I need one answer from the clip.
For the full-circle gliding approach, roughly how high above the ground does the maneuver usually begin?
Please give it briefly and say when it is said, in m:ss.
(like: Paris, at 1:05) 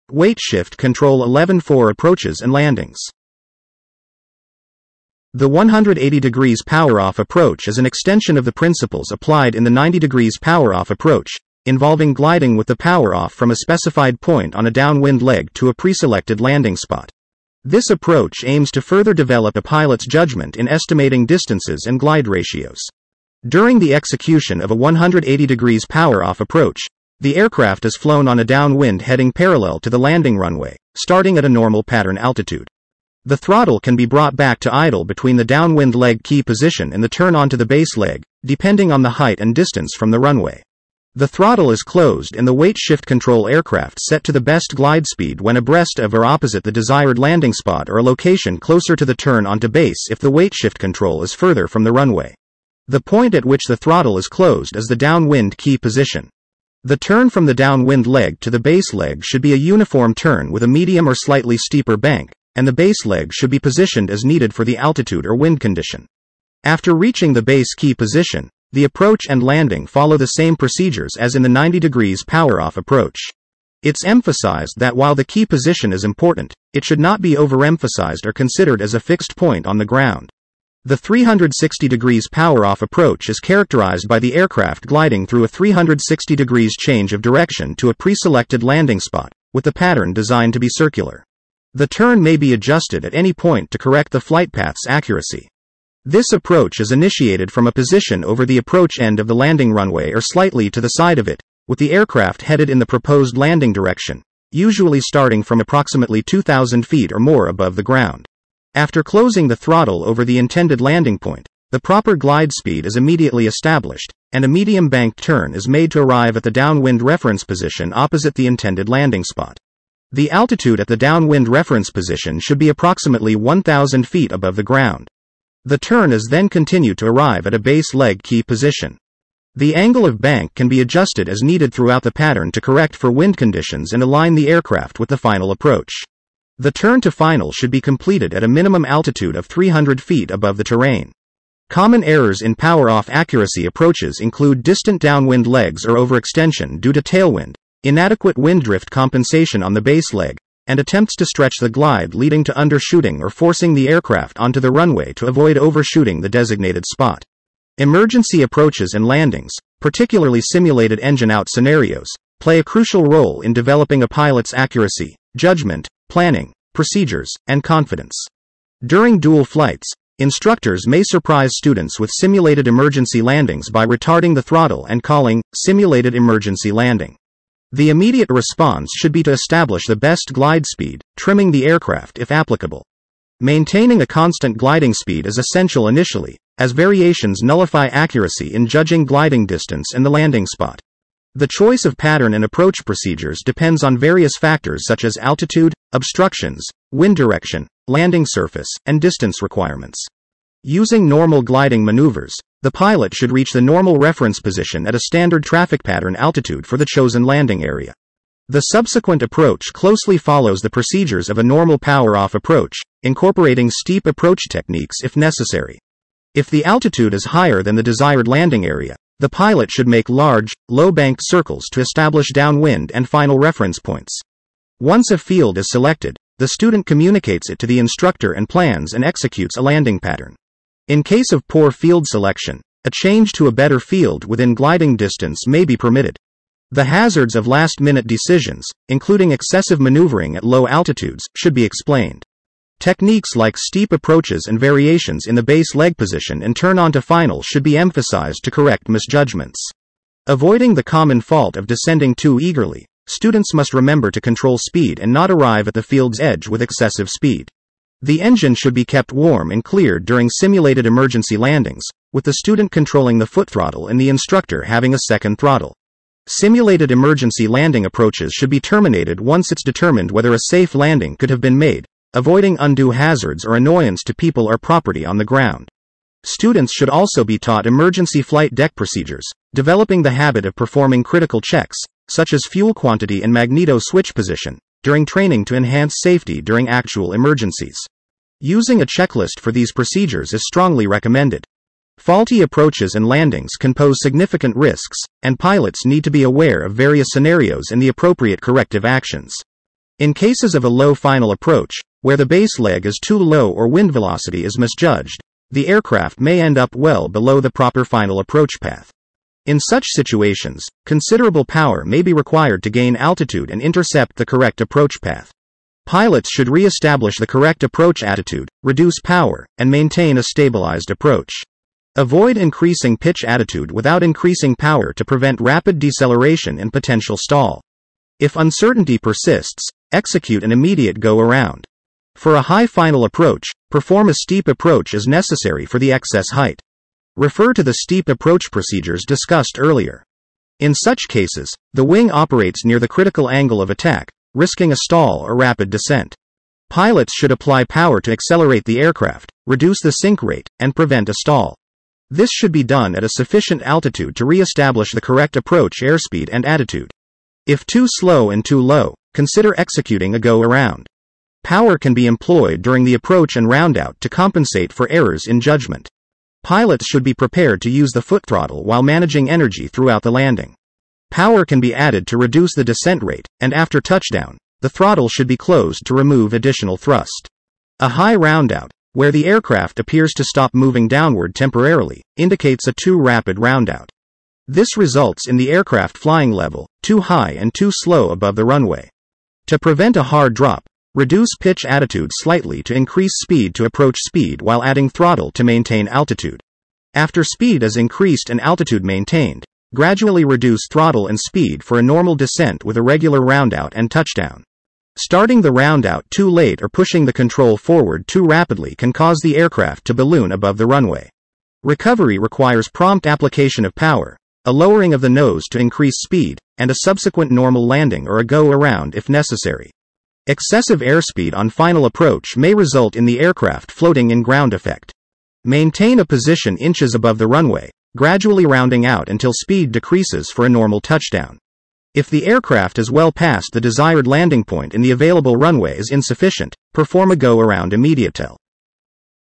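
2,000 feet, at 1:46.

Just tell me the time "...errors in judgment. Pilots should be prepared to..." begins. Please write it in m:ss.
6:04.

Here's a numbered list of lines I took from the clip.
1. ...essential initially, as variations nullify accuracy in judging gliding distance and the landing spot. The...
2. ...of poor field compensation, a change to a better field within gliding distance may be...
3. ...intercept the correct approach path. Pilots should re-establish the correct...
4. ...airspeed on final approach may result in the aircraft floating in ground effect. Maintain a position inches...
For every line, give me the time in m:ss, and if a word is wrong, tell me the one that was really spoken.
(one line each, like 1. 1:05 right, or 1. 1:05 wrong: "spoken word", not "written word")
1. 3:05 right
2. 3:51 wrong: "selection", not "compensation"
3. 5:13 right
4. 7:00 right.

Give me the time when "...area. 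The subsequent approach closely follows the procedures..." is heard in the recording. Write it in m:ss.
3:27.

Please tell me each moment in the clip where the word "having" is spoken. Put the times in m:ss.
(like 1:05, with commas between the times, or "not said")
4:24.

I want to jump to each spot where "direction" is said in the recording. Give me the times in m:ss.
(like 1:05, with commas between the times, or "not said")
1:27, 1:43, 3:17.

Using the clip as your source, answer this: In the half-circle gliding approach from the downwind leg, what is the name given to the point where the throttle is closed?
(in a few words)
downwind key position.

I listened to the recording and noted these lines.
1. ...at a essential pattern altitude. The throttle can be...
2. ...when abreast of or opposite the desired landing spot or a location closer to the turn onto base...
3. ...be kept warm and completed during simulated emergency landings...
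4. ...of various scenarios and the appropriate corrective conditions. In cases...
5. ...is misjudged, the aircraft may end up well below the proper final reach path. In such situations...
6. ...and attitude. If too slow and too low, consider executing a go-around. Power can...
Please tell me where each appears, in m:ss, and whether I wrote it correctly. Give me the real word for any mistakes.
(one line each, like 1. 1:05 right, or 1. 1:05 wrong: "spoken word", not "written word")
1. 0:31 wrong: "normal", not "essential"
2. 0:45 right
3. 4:18 wrong: "cleared", not "completed"
4. 4:56 wrong: "actions", not "conditions"
5. 5:04 wrong: "approach", not "reach"
6. 5:56 right.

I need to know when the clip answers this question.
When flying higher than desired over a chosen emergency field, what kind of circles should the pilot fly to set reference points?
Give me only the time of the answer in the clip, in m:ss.
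3:40.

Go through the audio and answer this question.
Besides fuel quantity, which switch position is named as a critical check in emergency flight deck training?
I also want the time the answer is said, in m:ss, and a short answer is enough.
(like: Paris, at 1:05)
magneto switch, at 4:43.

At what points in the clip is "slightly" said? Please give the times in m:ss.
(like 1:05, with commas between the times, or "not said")
1:01, 1:40, 6:32.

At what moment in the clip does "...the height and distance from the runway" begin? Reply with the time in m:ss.
0:39.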